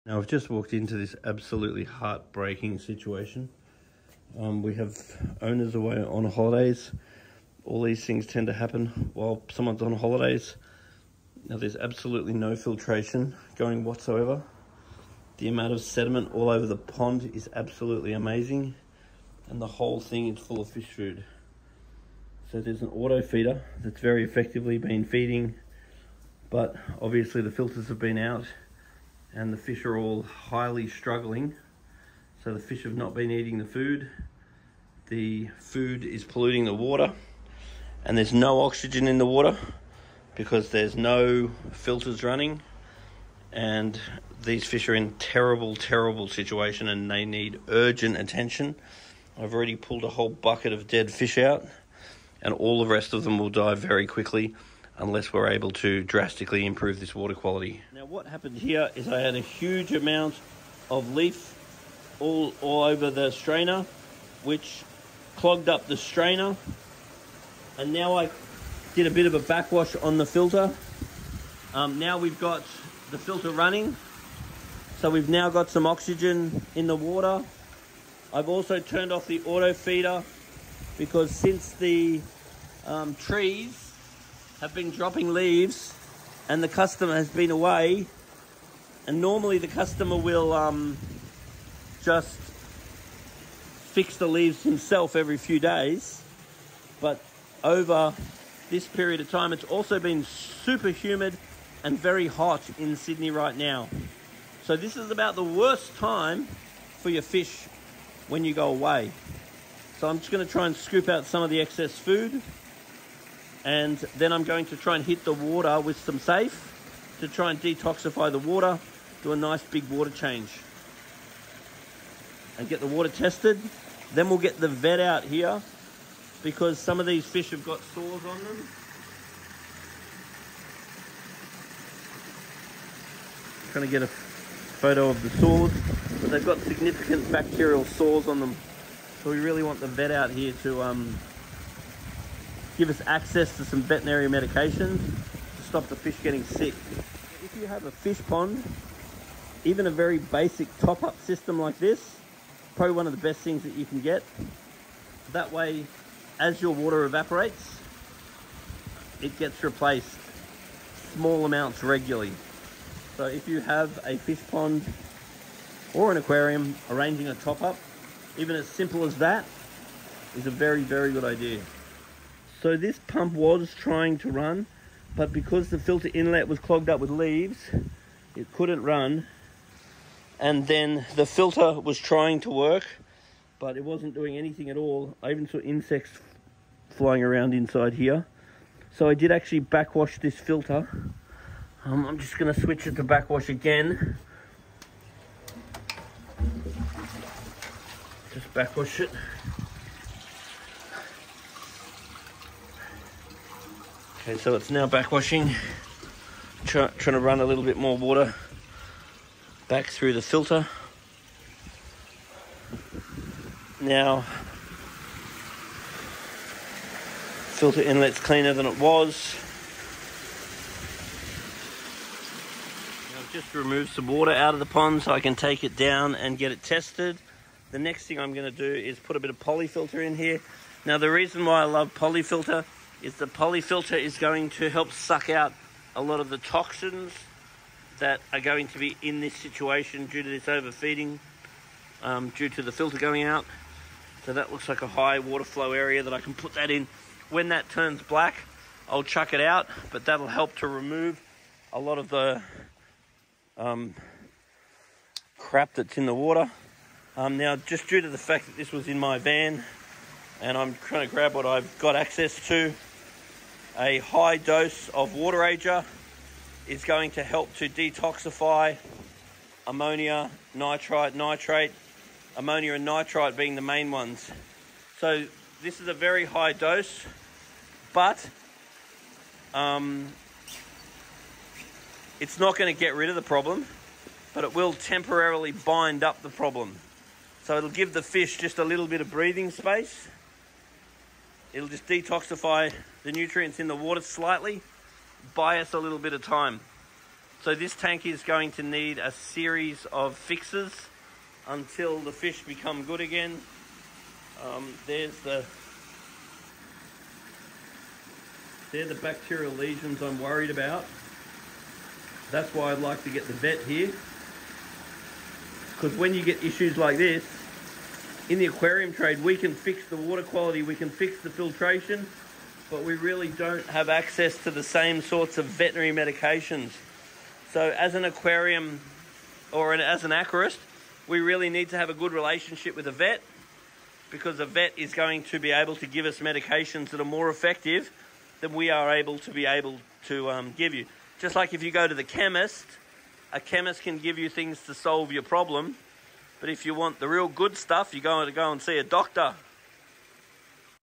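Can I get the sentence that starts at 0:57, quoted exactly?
Now, what happened here is I had a huge amount of leaf all, all over the strainer, which clogged up the strainer.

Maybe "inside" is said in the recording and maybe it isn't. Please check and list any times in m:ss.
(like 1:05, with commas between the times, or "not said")
3:07.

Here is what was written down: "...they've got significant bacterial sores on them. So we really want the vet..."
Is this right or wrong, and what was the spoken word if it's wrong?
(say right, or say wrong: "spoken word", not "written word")
right.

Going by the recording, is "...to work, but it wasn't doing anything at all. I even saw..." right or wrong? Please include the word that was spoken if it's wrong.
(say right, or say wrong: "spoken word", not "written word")
right.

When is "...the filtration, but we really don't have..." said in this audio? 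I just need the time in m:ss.
5:21.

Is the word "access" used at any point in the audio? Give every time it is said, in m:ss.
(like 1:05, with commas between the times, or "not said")
2:23, 4:21, 5:23.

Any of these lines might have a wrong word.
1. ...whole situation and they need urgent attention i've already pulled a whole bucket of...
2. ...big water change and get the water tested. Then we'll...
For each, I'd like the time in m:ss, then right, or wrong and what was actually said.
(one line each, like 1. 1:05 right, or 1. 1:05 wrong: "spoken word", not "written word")
1. 0:45 wrong: "terrible", not "whole"
2. 1:59 right.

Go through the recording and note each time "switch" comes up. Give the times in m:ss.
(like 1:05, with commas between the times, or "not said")
3:12.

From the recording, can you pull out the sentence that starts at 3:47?
The next thing I'm going to do is put a bit of polyfilter in here.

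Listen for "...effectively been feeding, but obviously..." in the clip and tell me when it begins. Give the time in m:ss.
0:24.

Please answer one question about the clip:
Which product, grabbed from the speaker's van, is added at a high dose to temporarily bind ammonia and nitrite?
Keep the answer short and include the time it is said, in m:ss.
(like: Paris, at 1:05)
Water Ager, at 4:25.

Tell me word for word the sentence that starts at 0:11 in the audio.
Now there's absolutely no filtration going whatsoever.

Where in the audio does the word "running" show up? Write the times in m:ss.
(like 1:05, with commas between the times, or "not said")
0:42, 1:13.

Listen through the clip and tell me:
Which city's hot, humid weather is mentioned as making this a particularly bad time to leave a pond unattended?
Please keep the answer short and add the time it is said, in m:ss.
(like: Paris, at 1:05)
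Sydney, at 1:42.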